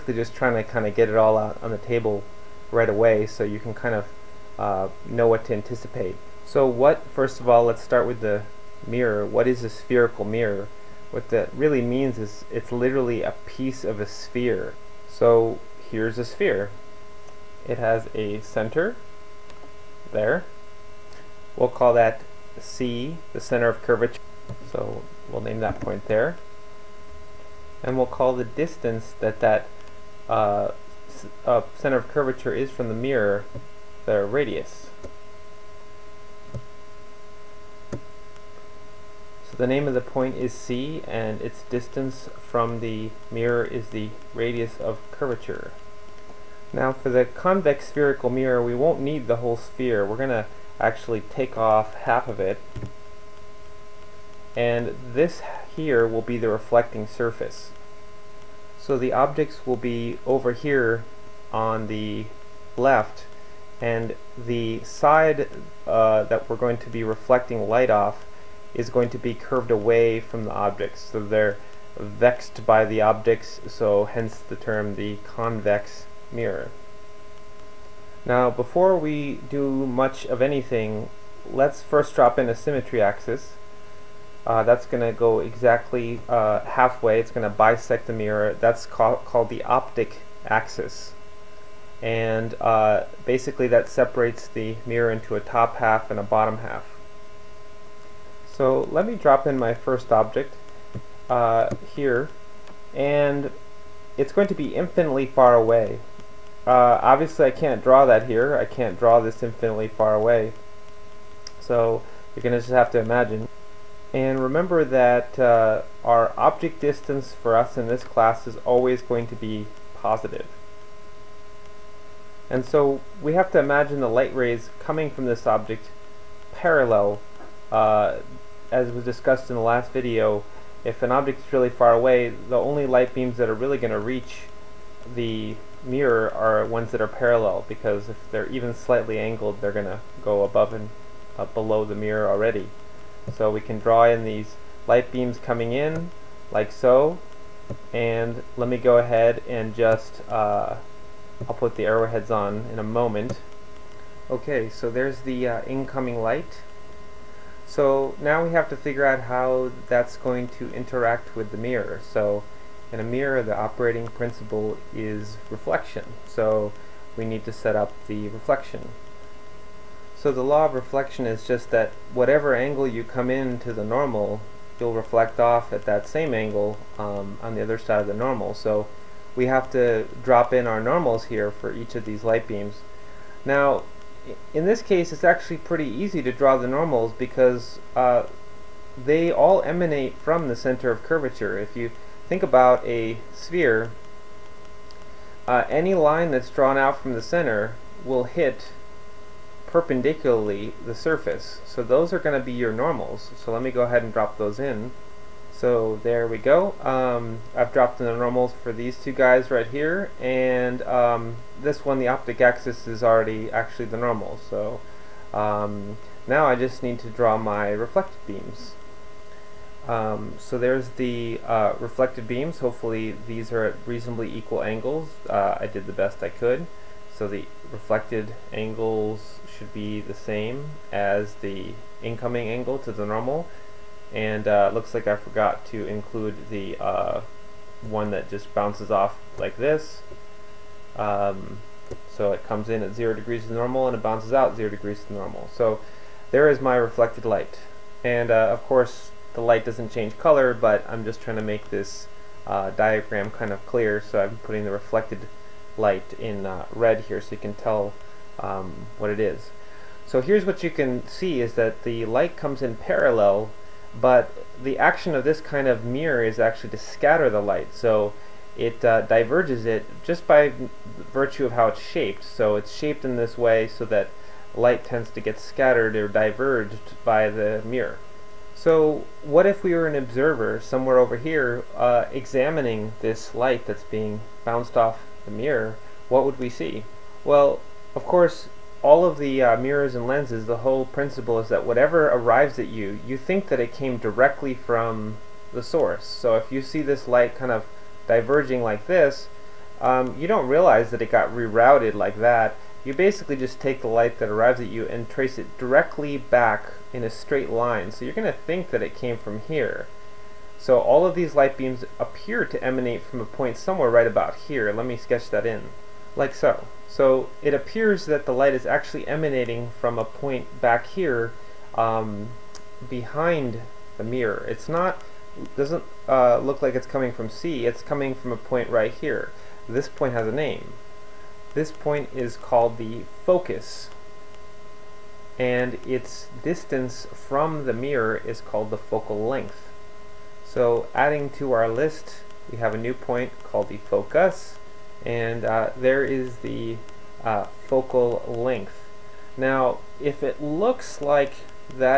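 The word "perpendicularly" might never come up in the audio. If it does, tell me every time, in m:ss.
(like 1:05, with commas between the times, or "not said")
3:19.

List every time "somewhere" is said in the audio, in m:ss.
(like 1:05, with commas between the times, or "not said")
4:40, 5:13.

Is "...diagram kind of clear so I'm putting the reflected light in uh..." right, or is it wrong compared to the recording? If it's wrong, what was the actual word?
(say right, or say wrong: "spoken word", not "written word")
right.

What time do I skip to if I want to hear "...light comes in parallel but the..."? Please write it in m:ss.
4:22.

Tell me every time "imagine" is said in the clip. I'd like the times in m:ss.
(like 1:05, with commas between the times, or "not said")
1:52, 2:03.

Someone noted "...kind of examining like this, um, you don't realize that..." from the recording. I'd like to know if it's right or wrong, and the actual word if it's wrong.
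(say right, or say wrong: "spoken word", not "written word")
wrong: "diverging", not "examining".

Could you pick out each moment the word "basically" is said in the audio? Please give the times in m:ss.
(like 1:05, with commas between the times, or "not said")
1:33, 5:02.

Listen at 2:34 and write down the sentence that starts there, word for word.
Okay, so there's the uh, incoming light.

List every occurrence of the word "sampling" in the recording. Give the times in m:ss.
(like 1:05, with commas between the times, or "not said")
not said.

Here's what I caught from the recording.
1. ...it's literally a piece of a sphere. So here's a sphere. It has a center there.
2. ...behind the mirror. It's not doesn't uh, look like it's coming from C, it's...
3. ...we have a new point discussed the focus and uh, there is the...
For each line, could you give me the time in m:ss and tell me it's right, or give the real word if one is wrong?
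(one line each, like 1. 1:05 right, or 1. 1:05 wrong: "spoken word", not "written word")
1. 0:12 right
2. 5:22 right
3. 5:42 wrong: "called", not "discussed".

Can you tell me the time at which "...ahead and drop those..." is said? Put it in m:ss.
3:23.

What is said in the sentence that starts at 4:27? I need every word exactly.
So it uh, diverges it just by virtue of how it's shaped.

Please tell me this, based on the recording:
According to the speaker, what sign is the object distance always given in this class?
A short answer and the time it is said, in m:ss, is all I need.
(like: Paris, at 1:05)
positive, at 1:58.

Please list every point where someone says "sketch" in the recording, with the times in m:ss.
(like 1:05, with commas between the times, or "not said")
5:14.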